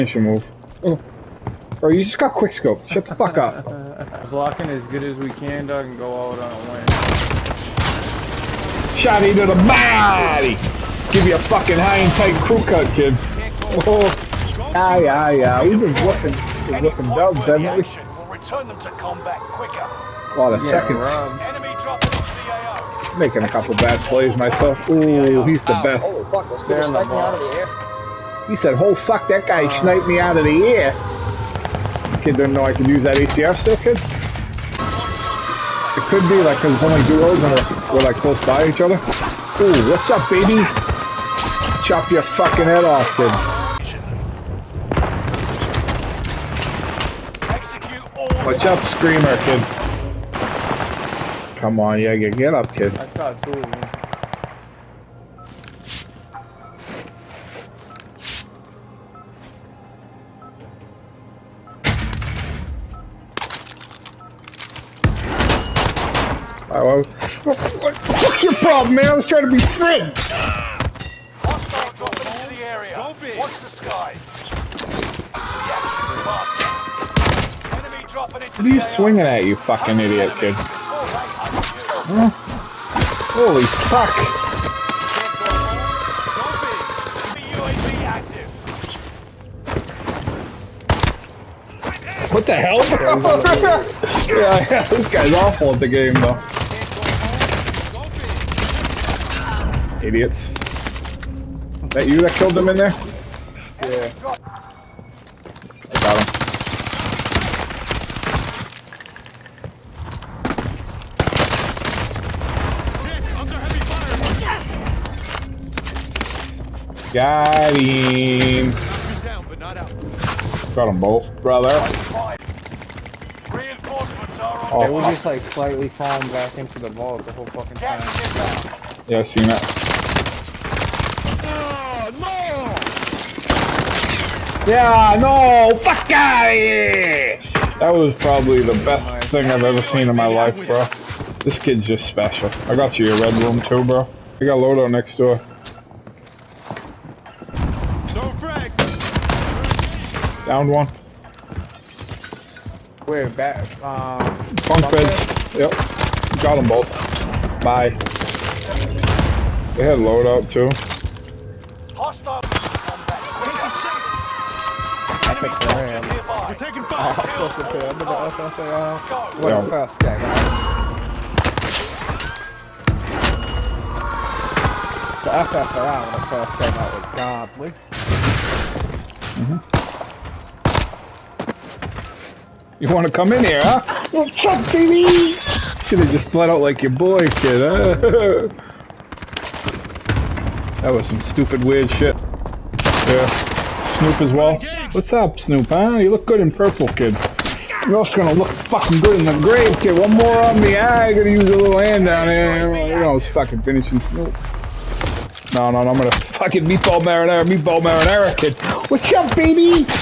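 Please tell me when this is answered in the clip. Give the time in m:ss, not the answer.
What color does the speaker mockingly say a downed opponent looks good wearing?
3:16.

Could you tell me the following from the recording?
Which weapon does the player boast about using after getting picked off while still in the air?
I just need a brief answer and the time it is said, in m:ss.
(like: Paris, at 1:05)
ACR, at 0:33.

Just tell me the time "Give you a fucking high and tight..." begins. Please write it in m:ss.
0:11.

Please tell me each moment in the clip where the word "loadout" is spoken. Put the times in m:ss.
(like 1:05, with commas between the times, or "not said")
2:24, 2:39.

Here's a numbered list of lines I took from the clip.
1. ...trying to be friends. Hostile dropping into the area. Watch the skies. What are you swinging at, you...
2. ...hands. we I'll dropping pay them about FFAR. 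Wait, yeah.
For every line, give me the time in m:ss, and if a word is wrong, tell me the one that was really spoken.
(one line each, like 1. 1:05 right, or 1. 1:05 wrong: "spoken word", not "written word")
1. 1:09 right
2. 2:46 wrong: "fucking", not "dropping".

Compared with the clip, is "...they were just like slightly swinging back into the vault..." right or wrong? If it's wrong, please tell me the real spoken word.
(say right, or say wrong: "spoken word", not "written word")
wrong: "falling", not "swinging".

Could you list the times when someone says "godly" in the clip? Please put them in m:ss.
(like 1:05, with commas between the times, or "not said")
2:57.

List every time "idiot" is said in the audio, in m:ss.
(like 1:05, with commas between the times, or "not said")
1:19, 1:40.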